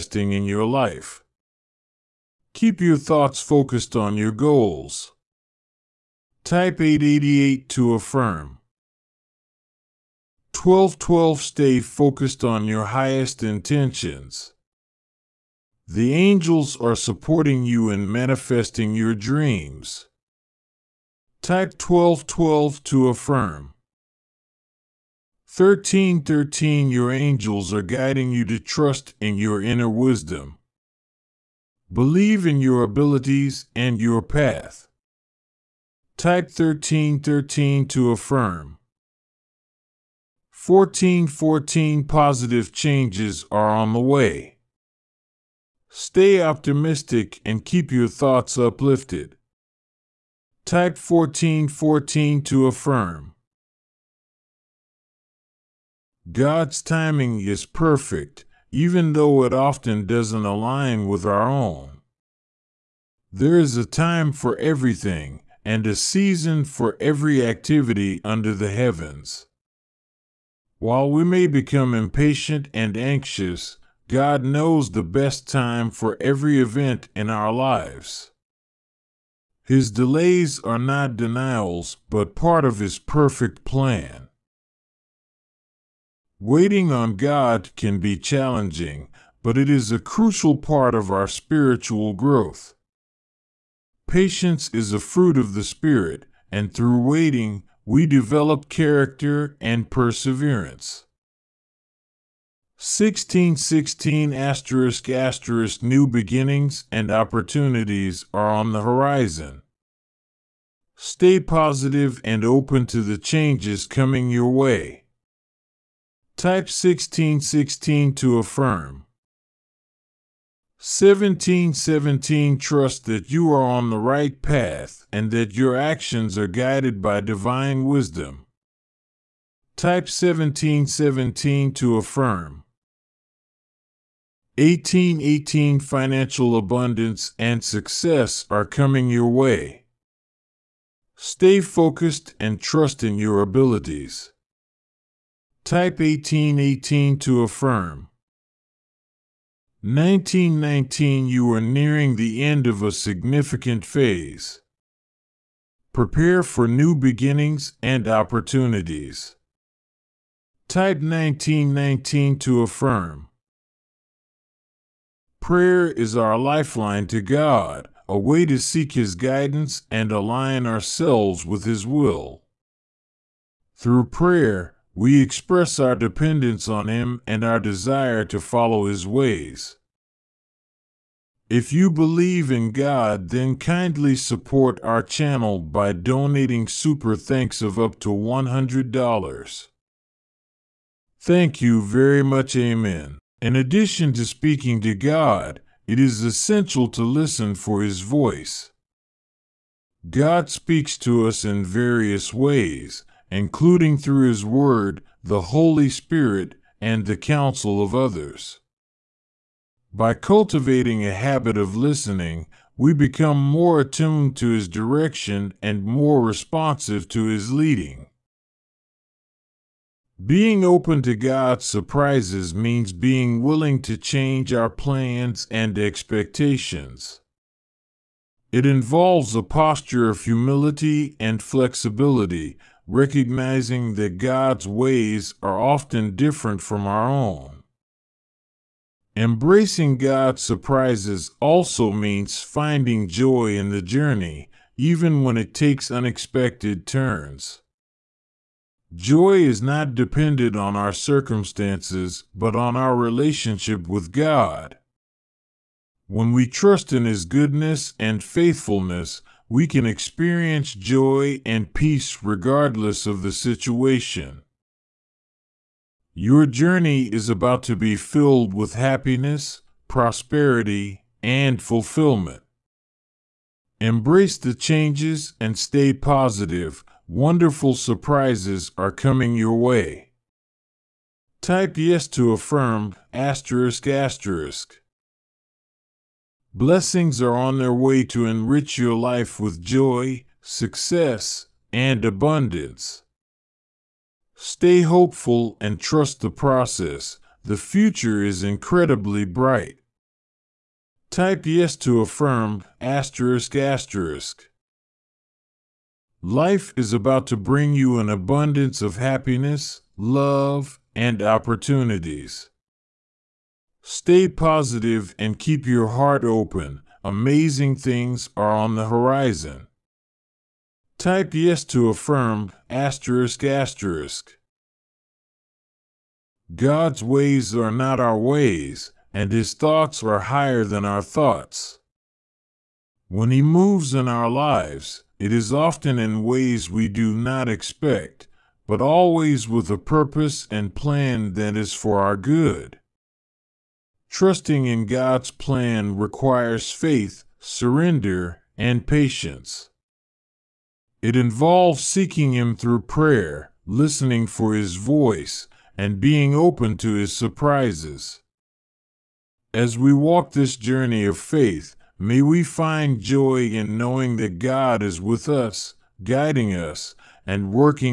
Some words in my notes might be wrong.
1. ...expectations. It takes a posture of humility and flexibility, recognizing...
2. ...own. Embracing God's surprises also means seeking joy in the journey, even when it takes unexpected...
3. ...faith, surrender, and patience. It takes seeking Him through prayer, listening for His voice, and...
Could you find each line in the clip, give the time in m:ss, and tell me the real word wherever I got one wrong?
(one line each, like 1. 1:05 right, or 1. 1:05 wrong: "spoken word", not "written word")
1. 3:45 wrong: "involves", not "takes"
2. 3:57 wrong: "finding", not "seeking"
3. 5:46 wrong: "involves", not "takes".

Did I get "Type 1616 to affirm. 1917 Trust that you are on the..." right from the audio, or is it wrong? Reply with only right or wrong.
wrong.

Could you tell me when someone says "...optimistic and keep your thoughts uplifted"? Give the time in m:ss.
0:46.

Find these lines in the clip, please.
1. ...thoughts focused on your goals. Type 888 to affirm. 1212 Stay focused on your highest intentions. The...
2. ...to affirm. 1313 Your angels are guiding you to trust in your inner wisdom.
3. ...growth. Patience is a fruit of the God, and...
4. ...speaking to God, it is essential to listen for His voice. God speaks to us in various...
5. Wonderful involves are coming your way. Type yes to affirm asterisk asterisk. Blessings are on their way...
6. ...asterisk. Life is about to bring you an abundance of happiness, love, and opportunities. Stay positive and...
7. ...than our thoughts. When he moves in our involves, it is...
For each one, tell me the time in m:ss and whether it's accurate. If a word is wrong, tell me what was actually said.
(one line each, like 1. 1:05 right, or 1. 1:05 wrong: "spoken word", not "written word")
1. 0:02 right
2. 0:22 right
3. 1:32 wrong: "Spirit", not "God"
4. 3:14 right
5. 4:37 wrong: "surprises", not "involves"
6. 5:03 right
7. 5:30 wrong: "lives", not "involves".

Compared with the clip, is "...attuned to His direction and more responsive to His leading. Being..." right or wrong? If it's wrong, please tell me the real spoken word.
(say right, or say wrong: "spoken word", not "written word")
right.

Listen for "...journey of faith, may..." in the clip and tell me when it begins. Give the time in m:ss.
6:00.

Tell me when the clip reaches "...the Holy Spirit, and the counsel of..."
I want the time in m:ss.
3:25.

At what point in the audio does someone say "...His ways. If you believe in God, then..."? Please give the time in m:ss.
2:58.